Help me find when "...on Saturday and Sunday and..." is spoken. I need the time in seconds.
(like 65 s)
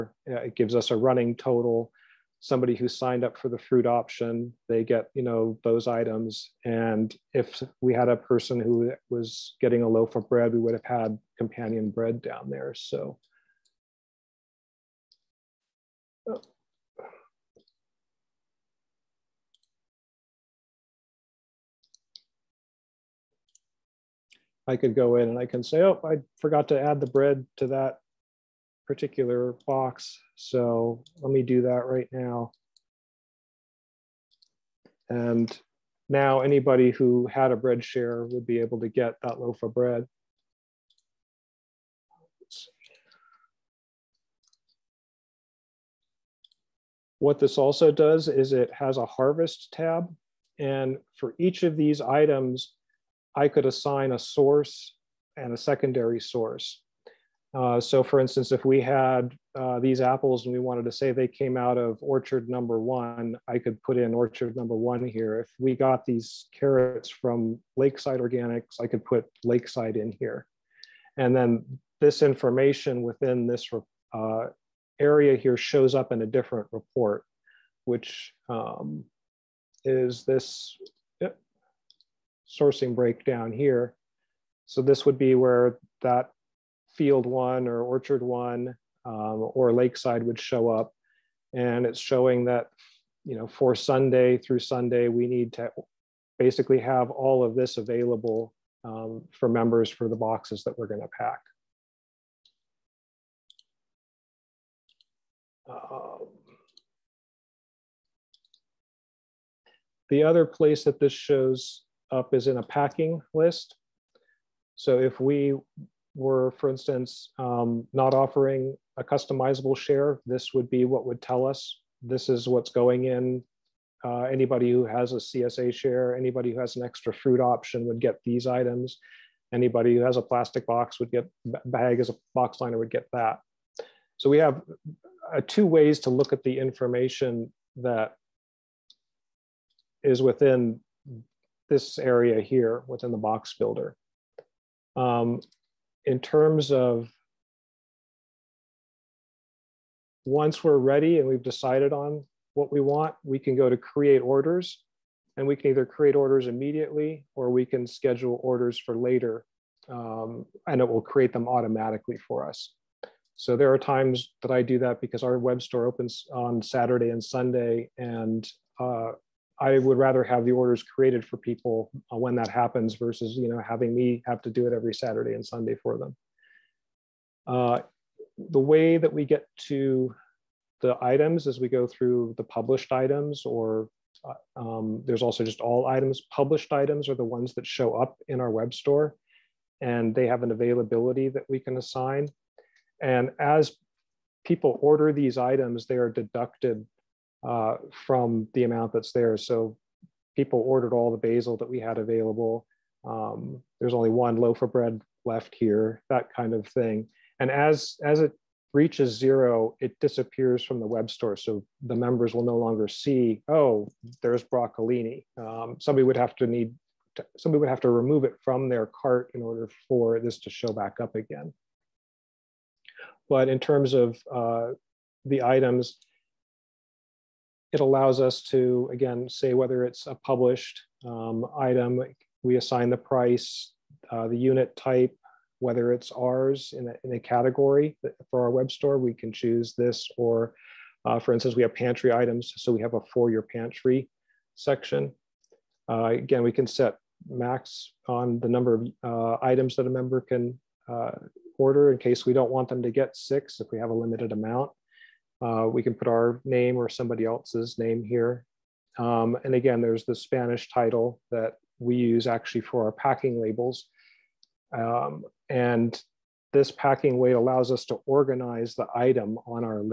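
166 s.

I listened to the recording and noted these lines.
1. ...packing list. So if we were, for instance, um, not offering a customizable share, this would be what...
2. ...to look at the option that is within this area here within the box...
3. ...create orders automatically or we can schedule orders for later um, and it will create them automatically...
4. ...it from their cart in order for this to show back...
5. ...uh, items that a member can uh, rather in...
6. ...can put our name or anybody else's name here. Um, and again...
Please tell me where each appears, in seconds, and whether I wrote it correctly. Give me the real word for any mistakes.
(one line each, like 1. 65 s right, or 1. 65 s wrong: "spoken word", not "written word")
1. 112 s right
2. 136 s wrong: "information", not "option"
3. 155 s wrong: "immediately", not "automatically"
4. 218 s right
5. 249 s wrong: "order", not "rather"
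6. 255 s wrong: "somebody", not "anybody".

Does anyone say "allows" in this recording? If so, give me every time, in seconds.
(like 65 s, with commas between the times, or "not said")
227 s, 267 s.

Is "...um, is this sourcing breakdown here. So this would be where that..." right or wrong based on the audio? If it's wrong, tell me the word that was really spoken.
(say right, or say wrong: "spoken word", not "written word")
right.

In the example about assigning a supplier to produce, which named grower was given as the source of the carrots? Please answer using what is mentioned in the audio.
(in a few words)
Lakeside Organics.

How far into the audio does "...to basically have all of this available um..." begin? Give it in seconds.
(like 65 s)
95 s.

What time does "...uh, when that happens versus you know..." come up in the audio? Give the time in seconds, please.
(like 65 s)
172 s.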